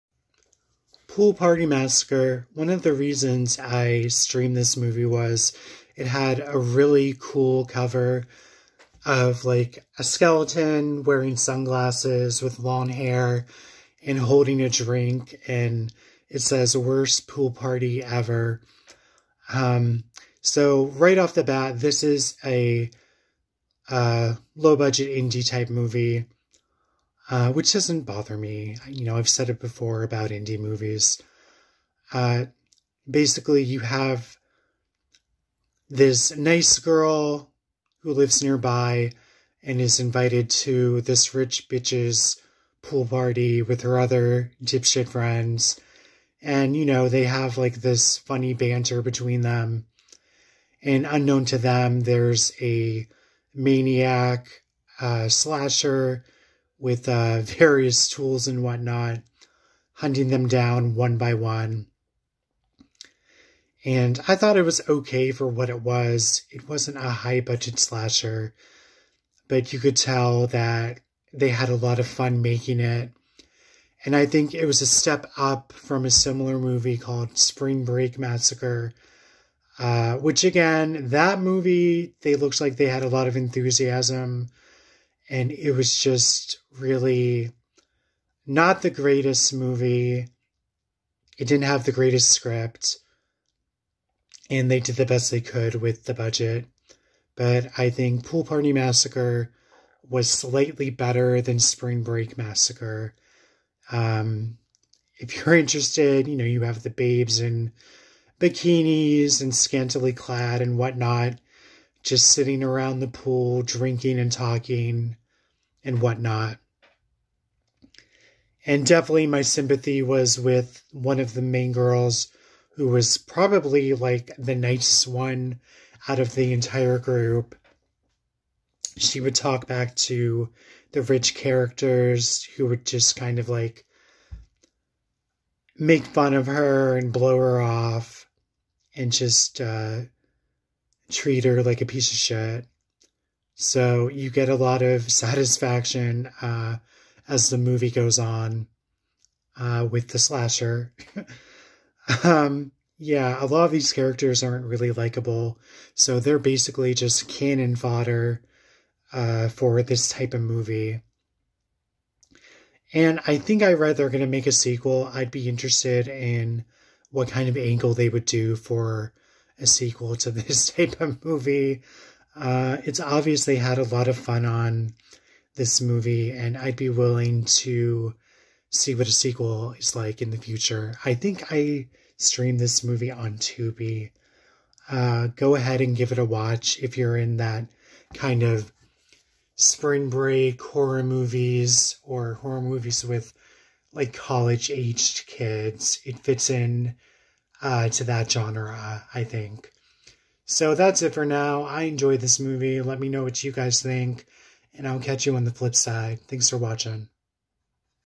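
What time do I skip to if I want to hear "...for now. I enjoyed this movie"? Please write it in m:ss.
3:21.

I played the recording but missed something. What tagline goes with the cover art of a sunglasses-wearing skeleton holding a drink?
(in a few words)
Worst pool party ever.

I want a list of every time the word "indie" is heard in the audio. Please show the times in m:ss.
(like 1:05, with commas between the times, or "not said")
0:25, 0:30.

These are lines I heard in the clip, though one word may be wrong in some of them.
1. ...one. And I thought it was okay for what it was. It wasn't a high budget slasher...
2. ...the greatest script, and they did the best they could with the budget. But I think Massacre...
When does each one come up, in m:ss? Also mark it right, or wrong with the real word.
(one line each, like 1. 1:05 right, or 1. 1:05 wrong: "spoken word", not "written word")
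1. 1:01 right
2. 1:31 wrong: "Pool", not "Massacre".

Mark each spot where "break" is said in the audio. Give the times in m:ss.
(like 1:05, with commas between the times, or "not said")
1:17, 1:42, 3:10.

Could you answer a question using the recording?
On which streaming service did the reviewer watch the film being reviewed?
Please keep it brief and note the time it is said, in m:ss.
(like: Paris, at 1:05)
Tubi, at 3:03.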